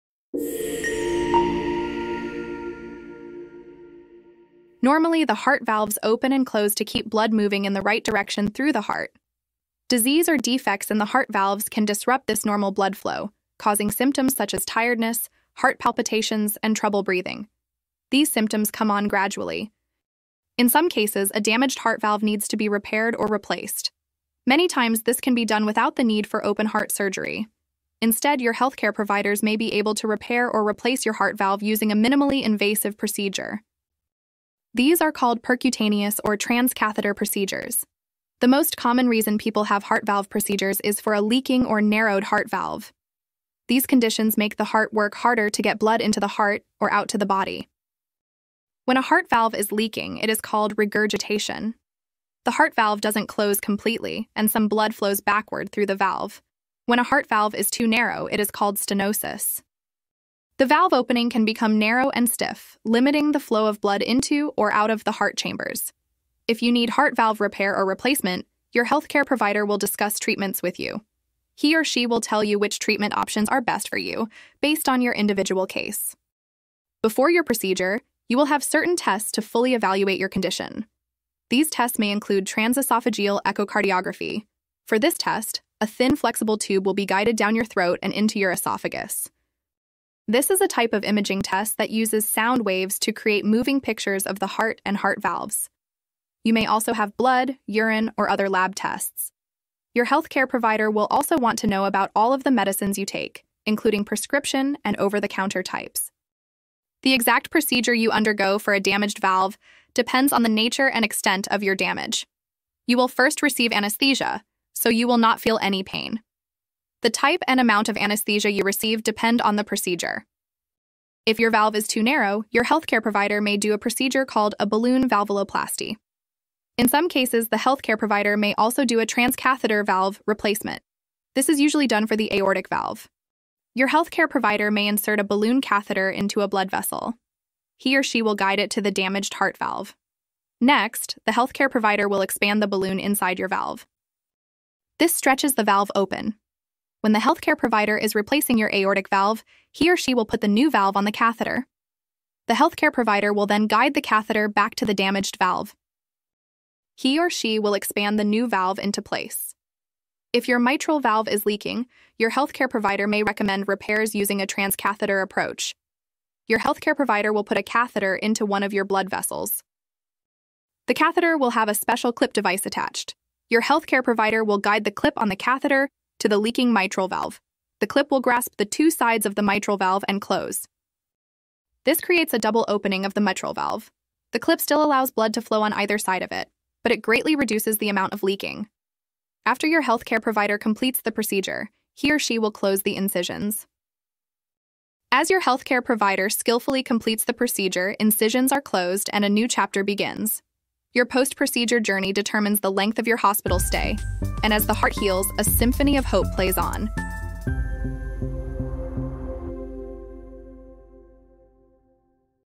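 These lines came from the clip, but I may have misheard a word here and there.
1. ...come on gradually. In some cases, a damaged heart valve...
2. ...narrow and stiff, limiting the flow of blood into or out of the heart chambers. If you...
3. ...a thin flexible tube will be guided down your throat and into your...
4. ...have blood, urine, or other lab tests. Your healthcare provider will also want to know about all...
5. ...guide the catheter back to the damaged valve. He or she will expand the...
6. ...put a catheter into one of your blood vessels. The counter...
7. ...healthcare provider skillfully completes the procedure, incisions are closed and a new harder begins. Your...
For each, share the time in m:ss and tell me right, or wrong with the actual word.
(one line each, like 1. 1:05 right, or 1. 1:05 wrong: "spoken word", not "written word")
1. 0:18 right
2. 1:01 right
3. 1:25 right
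4. 1:36 right
5. 2:33 right
6. 2:47 wrong: "catheter", not "counter"
7. 3:15 wrong: "chapter", not "harder".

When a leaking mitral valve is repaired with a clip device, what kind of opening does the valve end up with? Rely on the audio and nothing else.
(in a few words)
double opening.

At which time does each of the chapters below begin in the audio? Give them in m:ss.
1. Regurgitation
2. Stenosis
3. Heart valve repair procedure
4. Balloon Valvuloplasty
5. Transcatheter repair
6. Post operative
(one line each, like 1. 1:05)
1. 0:48
2. 0:58
3. 1:46
4. 2:02
5. 2:40
6. 3:12.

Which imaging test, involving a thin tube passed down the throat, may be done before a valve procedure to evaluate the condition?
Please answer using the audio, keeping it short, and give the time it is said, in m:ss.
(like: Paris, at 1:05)
transesophageal echocardiography, at 1:22.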